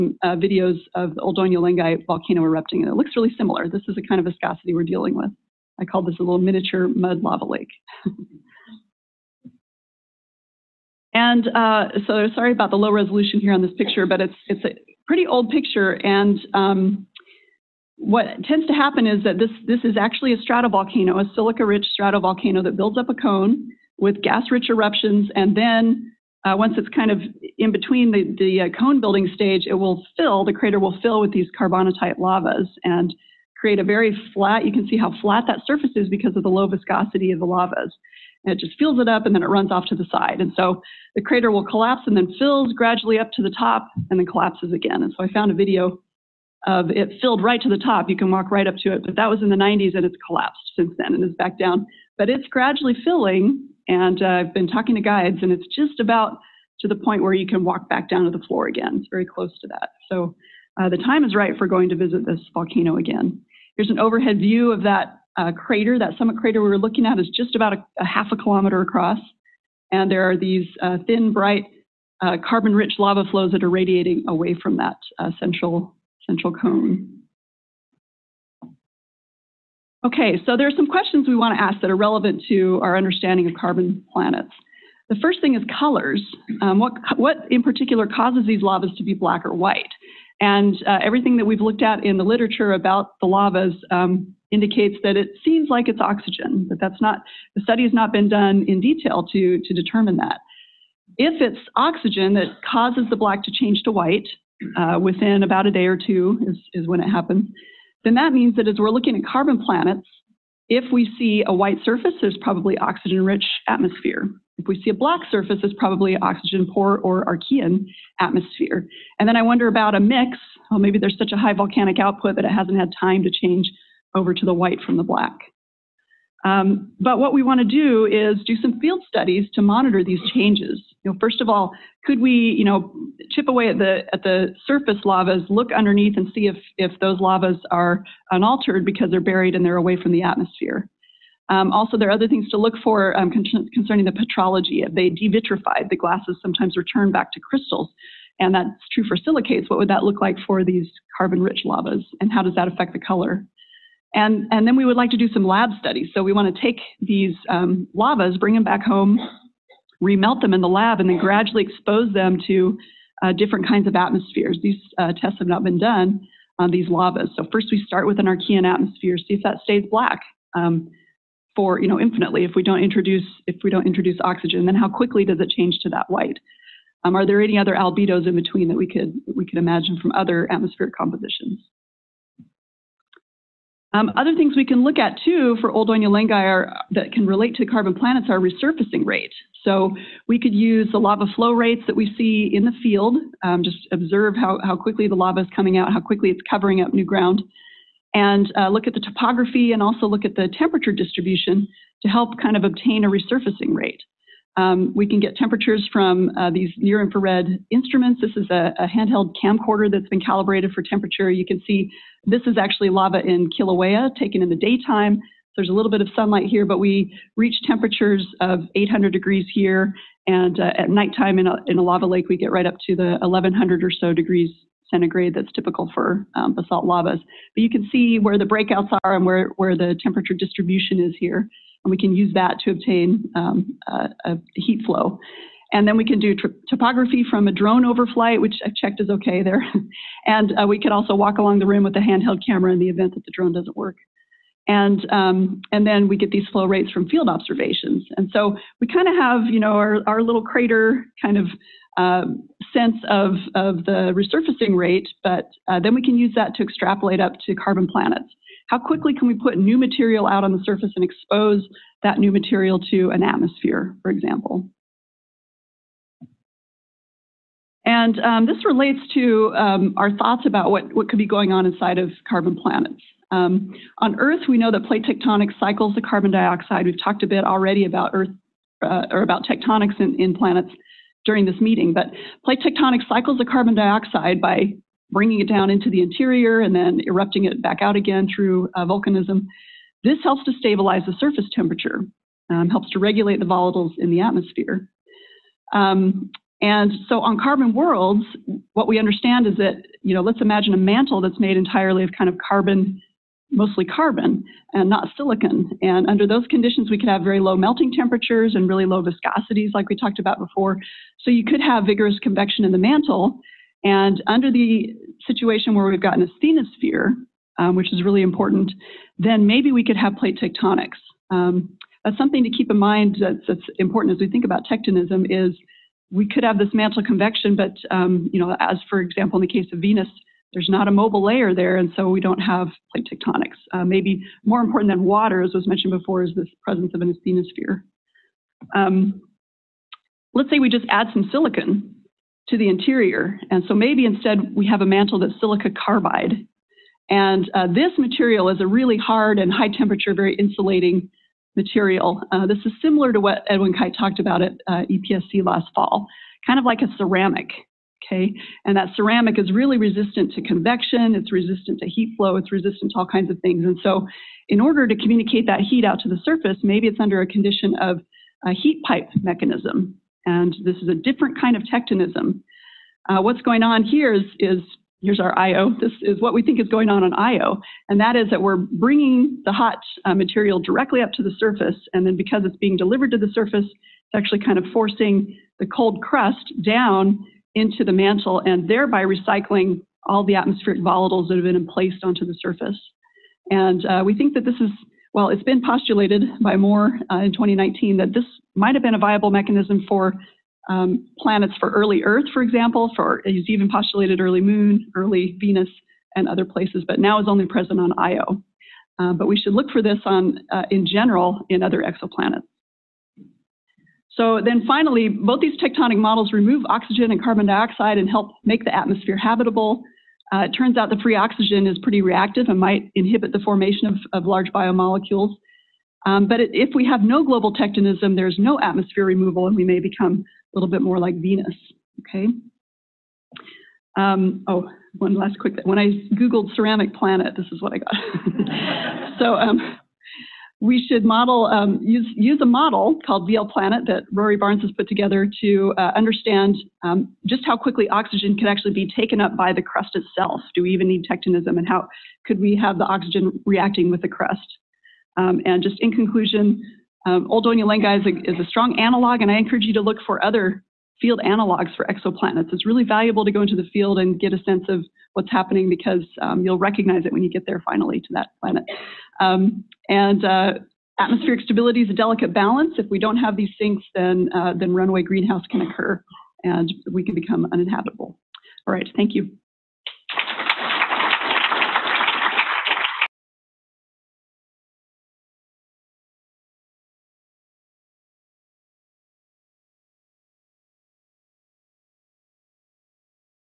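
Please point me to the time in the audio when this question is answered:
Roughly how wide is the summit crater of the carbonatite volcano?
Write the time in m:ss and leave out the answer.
1:07.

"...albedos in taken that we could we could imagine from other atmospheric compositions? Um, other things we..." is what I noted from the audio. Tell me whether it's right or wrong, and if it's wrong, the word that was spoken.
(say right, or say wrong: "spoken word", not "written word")
wrong: "between", not "taken".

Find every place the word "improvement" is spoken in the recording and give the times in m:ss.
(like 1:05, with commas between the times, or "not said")
not said.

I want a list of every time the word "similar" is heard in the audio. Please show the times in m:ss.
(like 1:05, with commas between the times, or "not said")
0:03, 5:52.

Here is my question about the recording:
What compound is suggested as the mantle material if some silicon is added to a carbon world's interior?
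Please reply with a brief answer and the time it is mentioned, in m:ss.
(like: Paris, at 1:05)
silica carbide, at 5:45.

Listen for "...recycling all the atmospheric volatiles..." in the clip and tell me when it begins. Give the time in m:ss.
6:29.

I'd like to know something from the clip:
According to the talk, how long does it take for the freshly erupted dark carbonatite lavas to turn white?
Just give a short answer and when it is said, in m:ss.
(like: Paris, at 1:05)
a day or two, at 1:45.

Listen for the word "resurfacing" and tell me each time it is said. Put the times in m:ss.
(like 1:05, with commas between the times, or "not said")
3:08, 3:23, 4:14.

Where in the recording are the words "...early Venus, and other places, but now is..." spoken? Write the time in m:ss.
6:44.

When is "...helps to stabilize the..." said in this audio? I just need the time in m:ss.
4:50.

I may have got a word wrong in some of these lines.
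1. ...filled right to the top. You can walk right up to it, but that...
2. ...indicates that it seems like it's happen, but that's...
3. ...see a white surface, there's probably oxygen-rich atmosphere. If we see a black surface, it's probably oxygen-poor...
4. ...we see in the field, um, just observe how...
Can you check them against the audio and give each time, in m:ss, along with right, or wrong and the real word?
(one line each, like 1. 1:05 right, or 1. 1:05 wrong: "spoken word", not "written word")
1. 0:47 right
2. 1:34 wrong: "oxygen", not "happen"
3. 1:51 right
4. 3:11 right.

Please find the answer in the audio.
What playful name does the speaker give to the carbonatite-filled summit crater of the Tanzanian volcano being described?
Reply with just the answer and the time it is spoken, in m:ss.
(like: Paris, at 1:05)
miniature mud lava lake, at 0:06.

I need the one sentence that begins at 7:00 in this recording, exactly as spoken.
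Uh, it turns out the free oxygen is pretty reactive and might inhibit the formation of, of large biomolecules.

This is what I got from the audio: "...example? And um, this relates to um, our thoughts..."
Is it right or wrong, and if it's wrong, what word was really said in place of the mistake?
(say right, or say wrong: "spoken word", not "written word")
right.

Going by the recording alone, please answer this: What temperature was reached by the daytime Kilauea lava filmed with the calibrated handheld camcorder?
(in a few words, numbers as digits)
800 degrees.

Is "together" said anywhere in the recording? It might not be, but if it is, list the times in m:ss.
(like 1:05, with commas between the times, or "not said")
7:24.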